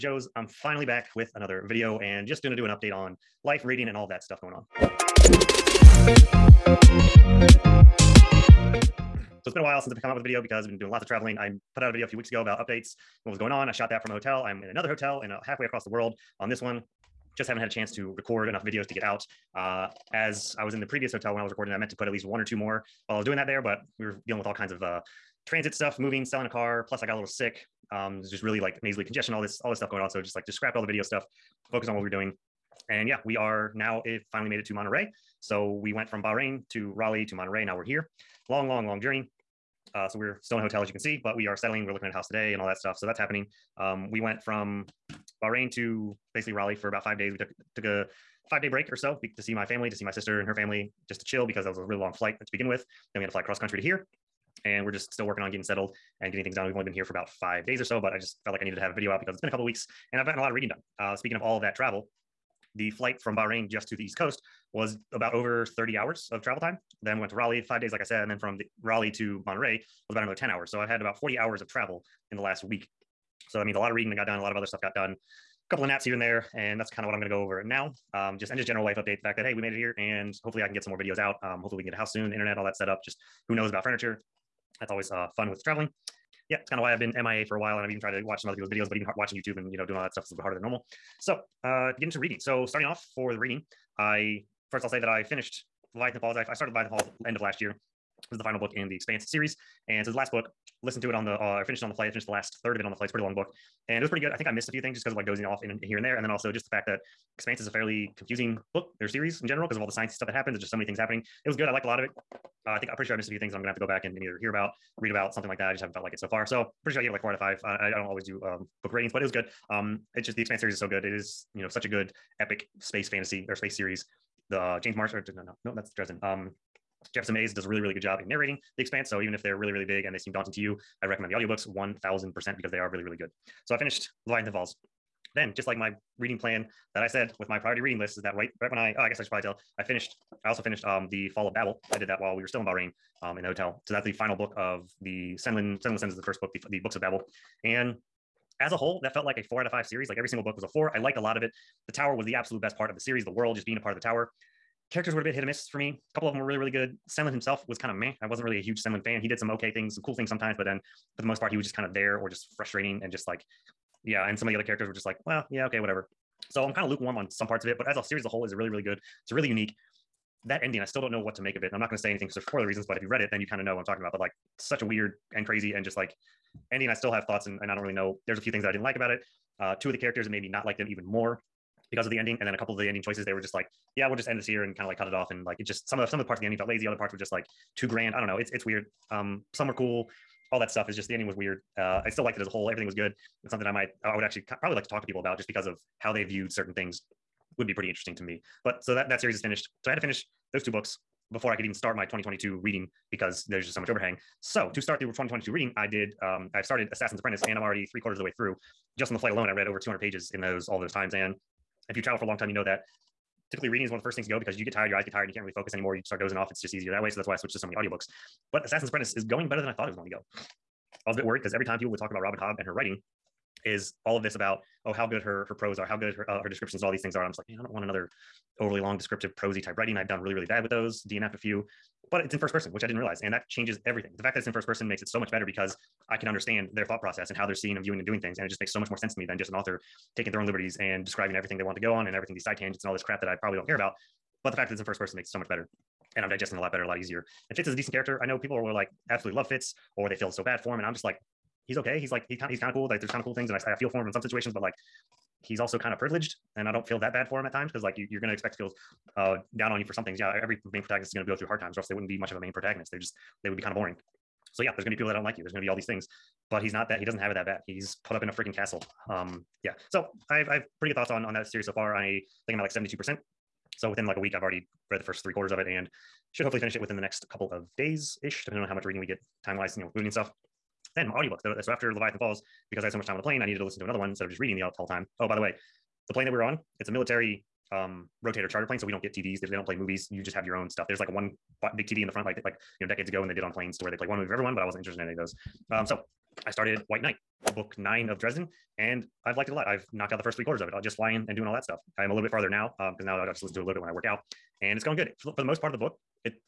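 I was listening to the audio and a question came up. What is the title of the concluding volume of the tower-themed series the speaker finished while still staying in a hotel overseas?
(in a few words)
The Fall of Babel.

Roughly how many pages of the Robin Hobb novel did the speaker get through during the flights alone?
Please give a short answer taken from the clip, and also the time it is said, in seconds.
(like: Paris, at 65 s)
200, at 209 s.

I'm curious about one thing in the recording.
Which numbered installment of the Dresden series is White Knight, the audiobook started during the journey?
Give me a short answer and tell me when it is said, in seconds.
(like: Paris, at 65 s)
9, at 297 s.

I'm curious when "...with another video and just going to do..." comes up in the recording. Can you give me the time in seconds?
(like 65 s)
1 s.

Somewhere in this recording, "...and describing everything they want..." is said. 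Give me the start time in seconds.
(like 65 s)
240 s.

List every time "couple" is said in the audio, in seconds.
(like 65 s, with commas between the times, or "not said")
59 s, 75 s, 156 s, 182 s, 277 s.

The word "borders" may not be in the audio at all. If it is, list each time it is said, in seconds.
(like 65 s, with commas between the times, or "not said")
not said.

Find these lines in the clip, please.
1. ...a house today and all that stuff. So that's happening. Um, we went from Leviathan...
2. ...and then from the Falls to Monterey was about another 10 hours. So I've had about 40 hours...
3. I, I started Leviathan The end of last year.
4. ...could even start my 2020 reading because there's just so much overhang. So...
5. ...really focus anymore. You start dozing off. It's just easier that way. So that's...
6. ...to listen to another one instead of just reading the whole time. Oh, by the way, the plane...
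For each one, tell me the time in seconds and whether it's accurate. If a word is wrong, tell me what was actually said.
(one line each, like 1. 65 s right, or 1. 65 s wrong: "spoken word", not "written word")
1. 42 s wrong: "Bahrain", not "Leviathan"
2. 68 s wrong: "Raleigh", not "Falls"
3. 96 s wrong: "Falls", not "The"
4. 201 s wrong: "2022", not "2020"
5. 215 s right
6. 283 s right.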